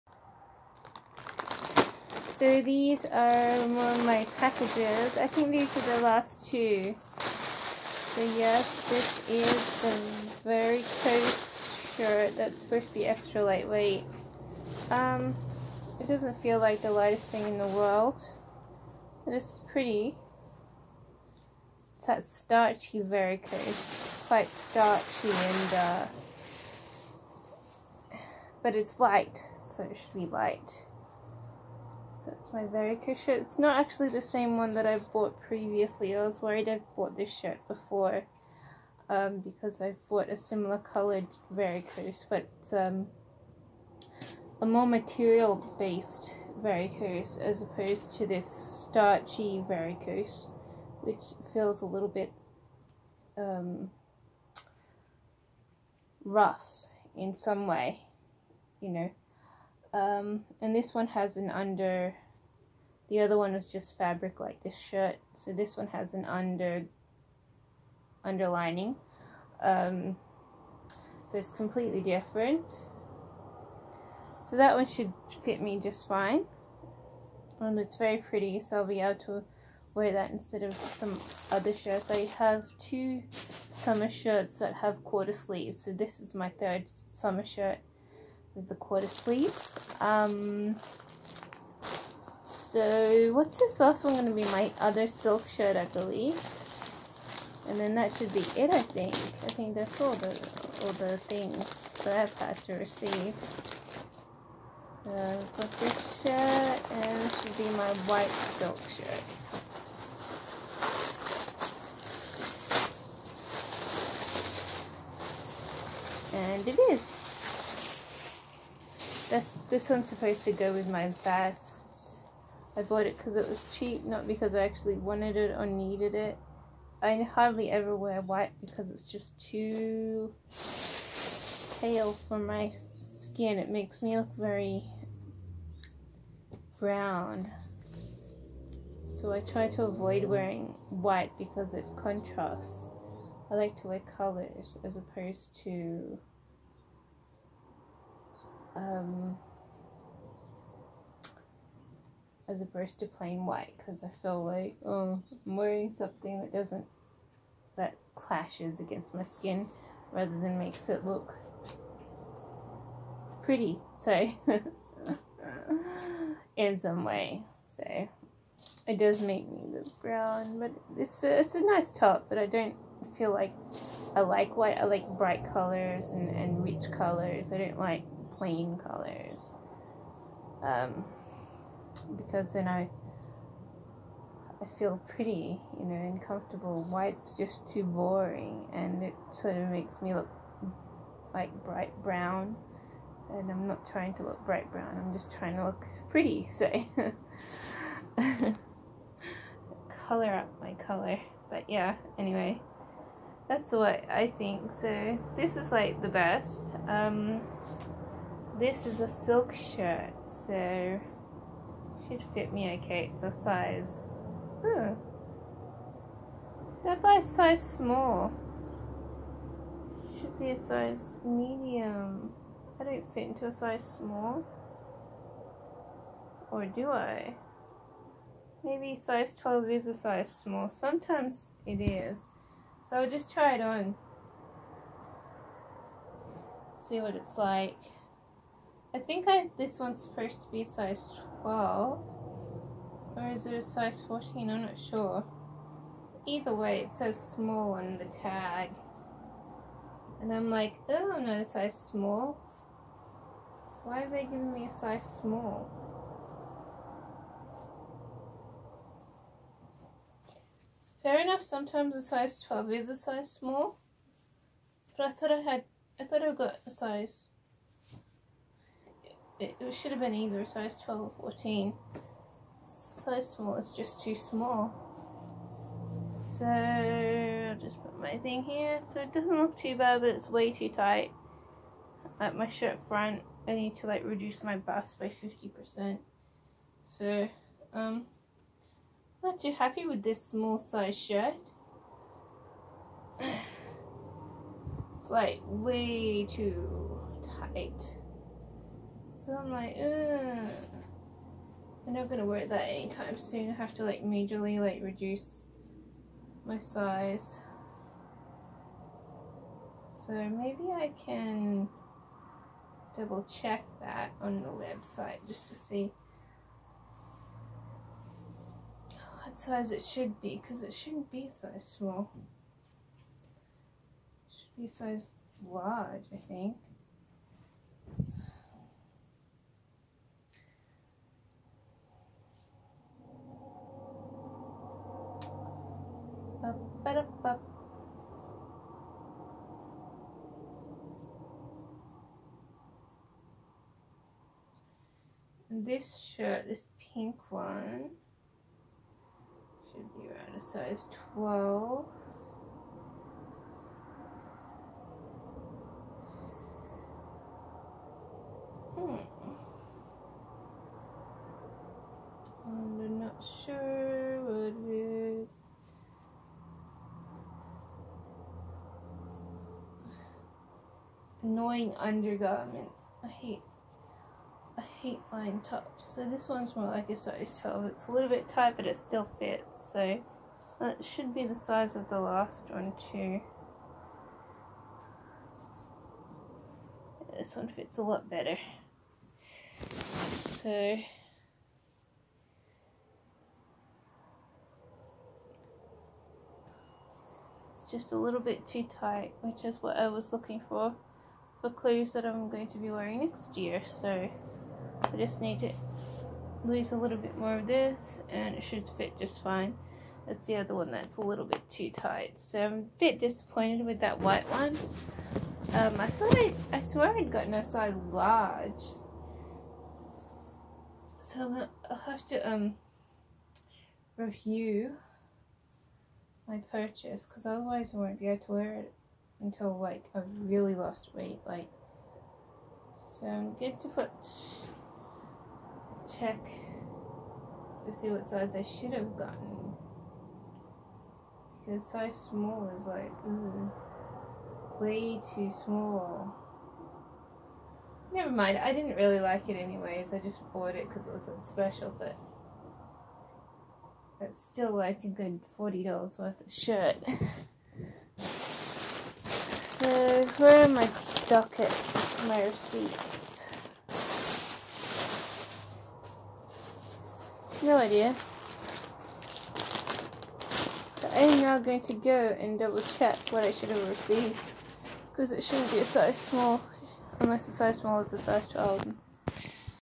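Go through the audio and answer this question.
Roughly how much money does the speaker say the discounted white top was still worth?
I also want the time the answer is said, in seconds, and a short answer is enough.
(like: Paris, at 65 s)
$40, at 455 s.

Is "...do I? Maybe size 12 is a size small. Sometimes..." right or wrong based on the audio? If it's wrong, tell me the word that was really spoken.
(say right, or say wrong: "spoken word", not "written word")
right.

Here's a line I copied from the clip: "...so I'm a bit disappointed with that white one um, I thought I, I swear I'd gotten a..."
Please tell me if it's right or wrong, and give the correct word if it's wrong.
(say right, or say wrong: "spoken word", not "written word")
right.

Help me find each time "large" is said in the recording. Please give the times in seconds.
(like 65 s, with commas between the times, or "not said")
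325 s, 417 s.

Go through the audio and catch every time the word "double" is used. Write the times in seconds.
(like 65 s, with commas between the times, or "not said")
312 s, 472 s.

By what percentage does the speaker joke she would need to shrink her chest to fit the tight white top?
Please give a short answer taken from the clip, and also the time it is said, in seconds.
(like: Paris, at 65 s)
50%, at 285 s.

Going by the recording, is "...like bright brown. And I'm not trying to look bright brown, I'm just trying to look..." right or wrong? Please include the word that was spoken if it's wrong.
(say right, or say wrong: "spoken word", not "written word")
right.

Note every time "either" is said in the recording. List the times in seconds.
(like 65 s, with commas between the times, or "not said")
246 s, 270 s.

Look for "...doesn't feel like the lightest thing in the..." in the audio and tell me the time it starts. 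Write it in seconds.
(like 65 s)
16 s.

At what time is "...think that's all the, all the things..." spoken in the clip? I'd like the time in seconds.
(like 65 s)
99 s.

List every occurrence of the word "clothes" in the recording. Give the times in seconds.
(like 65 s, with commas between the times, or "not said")
401 s.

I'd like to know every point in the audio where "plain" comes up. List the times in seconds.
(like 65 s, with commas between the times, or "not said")
153 s, 178 s.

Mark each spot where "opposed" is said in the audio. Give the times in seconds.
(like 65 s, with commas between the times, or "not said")
47 s, 144 s, 152 s.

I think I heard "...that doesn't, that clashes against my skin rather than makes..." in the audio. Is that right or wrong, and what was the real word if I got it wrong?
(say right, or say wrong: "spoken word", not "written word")
right.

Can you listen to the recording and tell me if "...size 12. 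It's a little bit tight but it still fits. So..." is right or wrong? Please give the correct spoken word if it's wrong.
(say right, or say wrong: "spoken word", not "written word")
right.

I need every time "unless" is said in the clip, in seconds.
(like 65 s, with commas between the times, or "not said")
476 s.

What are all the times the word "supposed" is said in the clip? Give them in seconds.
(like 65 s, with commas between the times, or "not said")
12 s, 120 s, 240 s.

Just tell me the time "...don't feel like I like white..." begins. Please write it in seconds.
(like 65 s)
172 s.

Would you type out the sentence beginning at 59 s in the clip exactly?
Um, and this one has an under, the other one was just fabric like this shirt.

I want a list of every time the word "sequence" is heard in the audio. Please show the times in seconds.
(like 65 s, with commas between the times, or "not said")
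not said.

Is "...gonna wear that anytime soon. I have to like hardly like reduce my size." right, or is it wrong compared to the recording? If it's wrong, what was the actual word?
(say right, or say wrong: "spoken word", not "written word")
wrong: "majorly", not "hardly".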